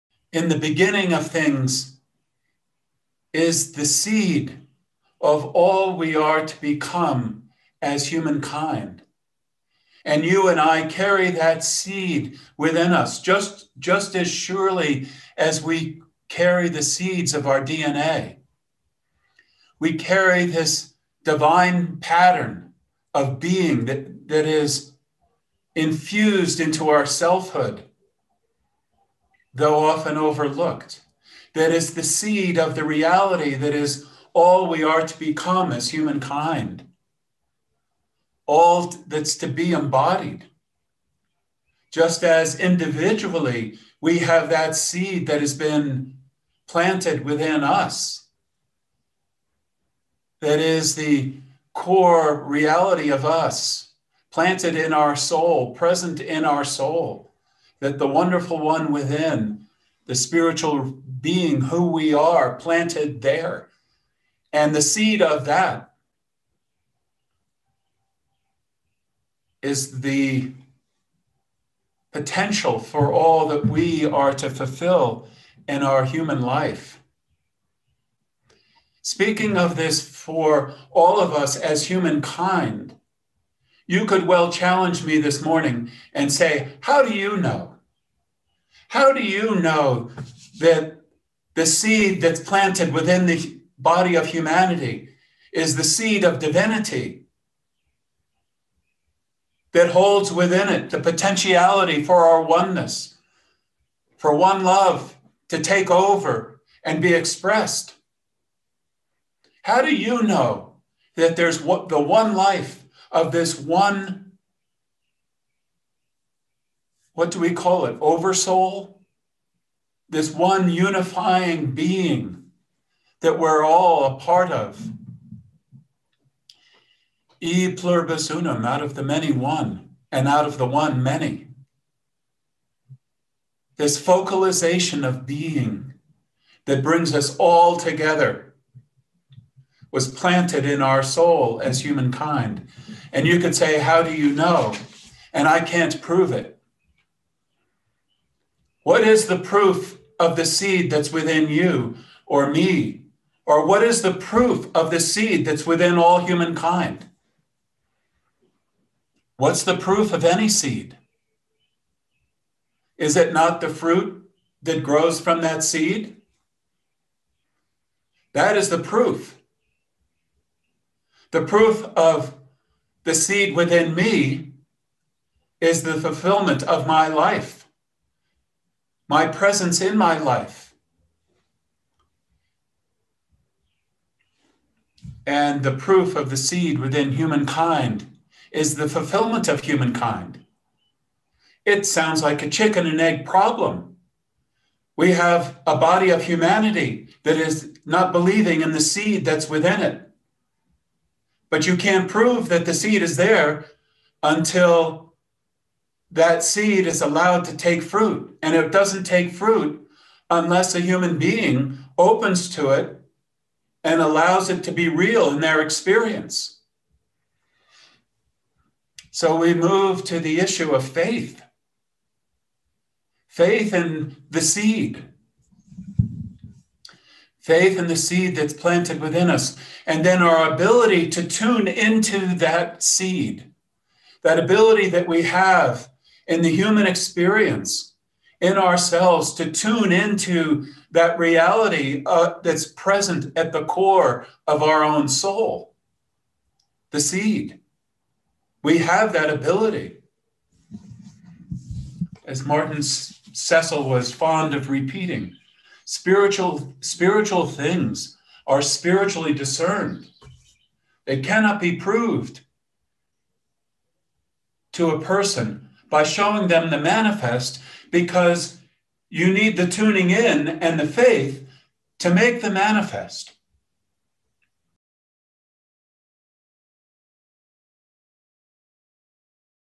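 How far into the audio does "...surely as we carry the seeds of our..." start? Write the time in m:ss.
0:14.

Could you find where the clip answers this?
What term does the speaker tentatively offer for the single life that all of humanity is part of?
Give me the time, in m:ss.
1:58.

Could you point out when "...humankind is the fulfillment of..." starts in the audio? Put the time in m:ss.
3:07.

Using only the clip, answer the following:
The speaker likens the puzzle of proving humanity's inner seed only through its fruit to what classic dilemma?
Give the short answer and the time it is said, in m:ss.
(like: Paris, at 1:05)
chicken and egg, at 3:12.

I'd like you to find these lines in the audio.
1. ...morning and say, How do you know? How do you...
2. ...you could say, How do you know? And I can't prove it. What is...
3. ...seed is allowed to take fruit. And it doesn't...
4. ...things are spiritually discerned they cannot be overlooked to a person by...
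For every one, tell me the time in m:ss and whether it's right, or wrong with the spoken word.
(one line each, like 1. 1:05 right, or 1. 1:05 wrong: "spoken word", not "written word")
1. 1:25 right
2. 2:23 right
3. 3:26 right
4. 4:17 wrong: "proved", not "overlooked".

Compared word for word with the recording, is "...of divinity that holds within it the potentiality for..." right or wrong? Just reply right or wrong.
right.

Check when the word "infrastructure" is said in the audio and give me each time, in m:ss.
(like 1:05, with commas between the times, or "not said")
not said.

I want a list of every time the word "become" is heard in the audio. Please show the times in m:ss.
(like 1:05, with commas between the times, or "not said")
0:06, 0:35.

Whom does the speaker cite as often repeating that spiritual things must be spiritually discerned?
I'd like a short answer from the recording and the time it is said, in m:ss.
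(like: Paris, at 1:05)
Martin Cecil, at 4:12.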